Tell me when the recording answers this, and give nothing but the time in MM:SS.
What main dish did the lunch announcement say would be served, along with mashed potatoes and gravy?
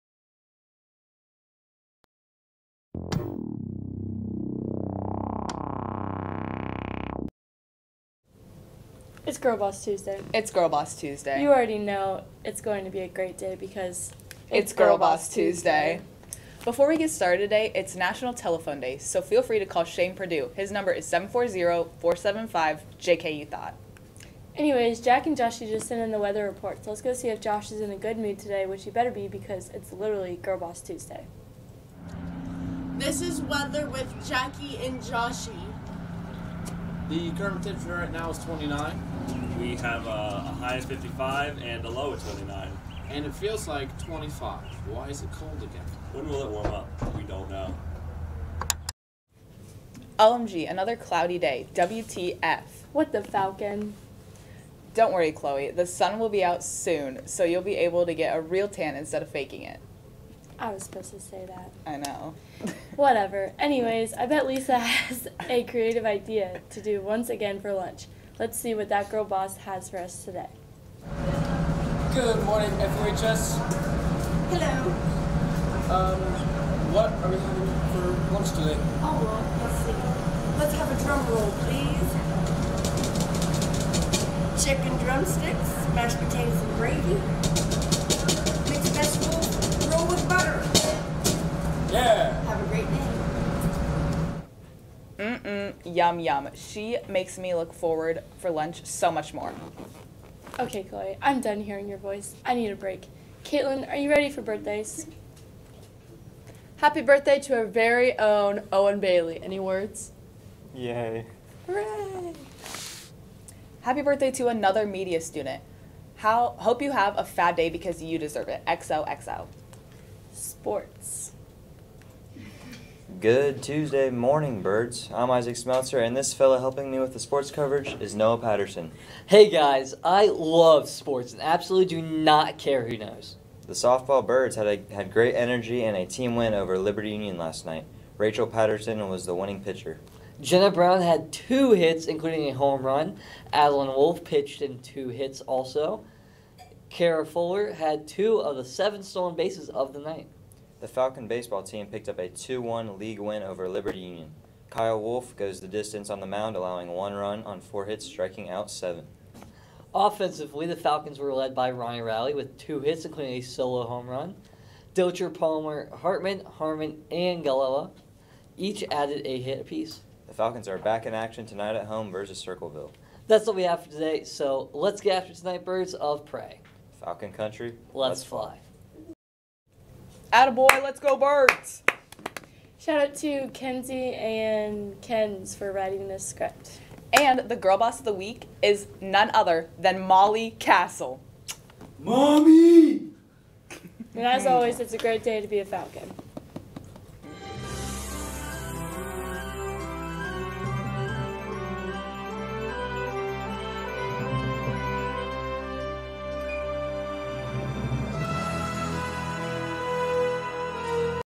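01:24.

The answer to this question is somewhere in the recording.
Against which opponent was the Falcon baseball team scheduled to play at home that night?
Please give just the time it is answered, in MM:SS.
02:52.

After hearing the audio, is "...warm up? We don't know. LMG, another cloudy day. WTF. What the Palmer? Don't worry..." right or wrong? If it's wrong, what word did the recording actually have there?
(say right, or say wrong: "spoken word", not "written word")
wrong: "Falcon", not "Palmer".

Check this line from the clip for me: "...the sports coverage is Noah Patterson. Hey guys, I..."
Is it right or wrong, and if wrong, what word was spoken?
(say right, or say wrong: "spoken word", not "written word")
right.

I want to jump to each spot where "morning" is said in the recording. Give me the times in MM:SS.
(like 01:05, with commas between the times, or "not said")
01:12, 02:04.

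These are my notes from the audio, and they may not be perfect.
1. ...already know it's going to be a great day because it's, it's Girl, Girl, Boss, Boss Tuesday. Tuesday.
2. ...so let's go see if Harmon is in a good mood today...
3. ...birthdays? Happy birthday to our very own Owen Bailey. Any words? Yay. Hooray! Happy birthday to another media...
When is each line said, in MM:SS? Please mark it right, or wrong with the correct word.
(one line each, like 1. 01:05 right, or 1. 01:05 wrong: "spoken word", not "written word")
1. 00:11 right
2. 00:26 wrong: "Josh", not "Harmon"
3. 01:44 right.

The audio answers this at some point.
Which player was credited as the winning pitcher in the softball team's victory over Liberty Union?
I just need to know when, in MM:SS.
02:18.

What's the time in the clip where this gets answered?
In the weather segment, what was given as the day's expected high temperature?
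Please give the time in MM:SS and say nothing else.
00:40.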